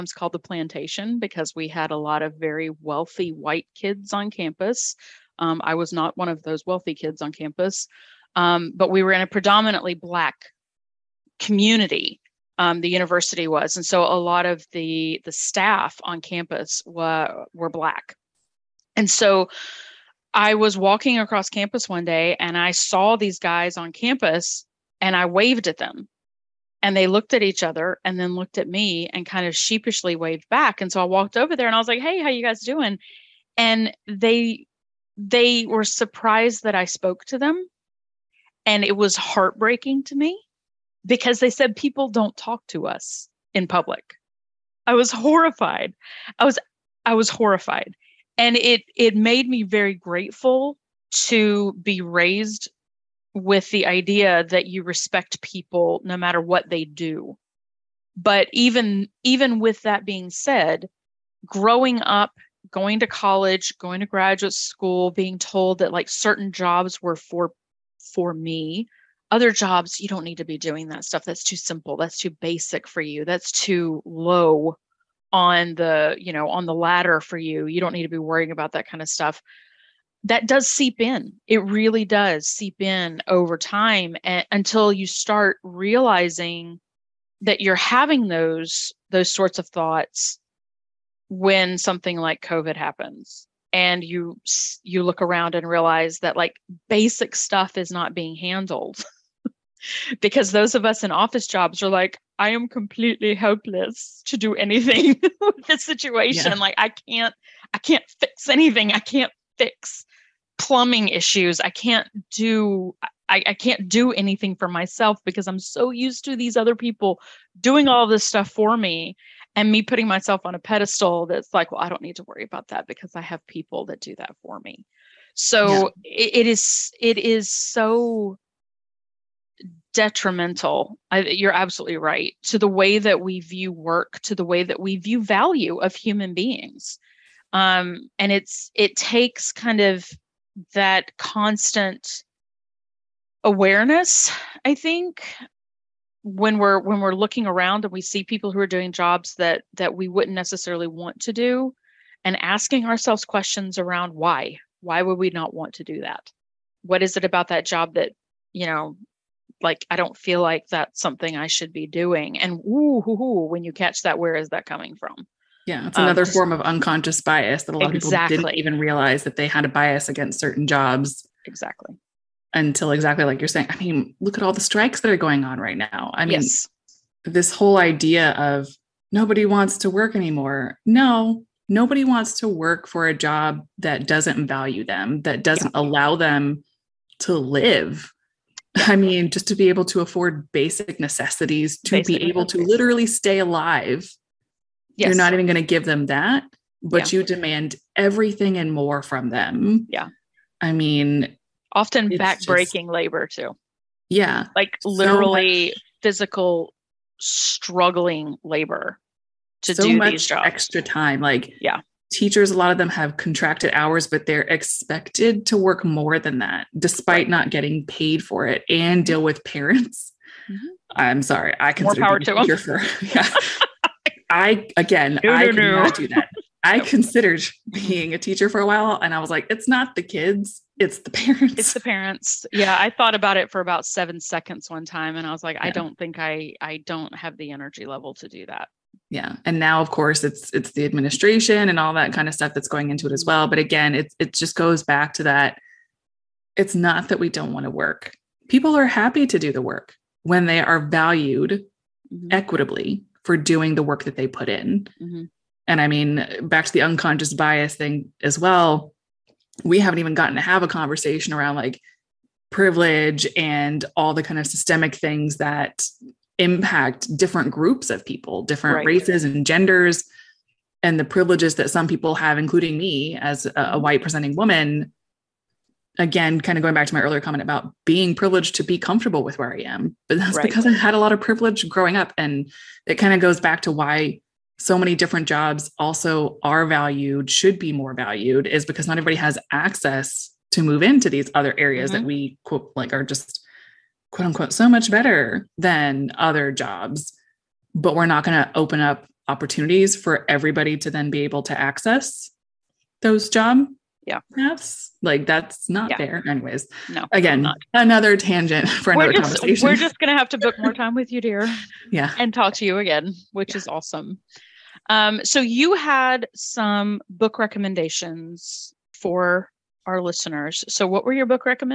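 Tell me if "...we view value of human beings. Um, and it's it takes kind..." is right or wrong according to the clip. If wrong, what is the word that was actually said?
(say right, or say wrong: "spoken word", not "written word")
right.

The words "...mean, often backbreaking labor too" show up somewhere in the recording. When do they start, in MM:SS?
03:20.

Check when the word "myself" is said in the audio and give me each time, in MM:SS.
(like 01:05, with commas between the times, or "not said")
01:54, 02:00.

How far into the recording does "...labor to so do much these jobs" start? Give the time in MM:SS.
03:28.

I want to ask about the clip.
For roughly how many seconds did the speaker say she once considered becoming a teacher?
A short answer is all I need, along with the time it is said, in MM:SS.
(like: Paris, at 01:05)
7, at 03:53.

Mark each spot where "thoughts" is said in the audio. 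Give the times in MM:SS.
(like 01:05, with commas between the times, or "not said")
01:29, 03:52.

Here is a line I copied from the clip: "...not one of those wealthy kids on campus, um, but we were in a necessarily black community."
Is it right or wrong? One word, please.
wrong.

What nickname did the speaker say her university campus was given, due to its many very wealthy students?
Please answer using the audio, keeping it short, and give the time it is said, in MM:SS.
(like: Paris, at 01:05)
The plantation, at 00:00.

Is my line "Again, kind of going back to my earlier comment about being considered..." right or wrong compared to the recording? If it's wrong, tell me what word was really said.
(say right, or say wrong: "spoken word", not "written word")
wrong: "privileged", not "considered".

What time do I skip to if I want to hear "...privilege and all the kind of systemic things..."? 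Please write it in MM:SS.
04:22.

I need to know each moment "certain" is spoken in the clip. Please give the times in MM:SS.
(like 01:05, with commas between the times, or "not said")
01:06, 02:50.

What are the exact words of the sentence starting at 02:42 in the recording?
And ooh, hoo, hoo, when you catch that, where is that coming from?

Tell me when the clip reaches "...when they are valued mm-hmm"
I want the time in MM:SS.
04:10.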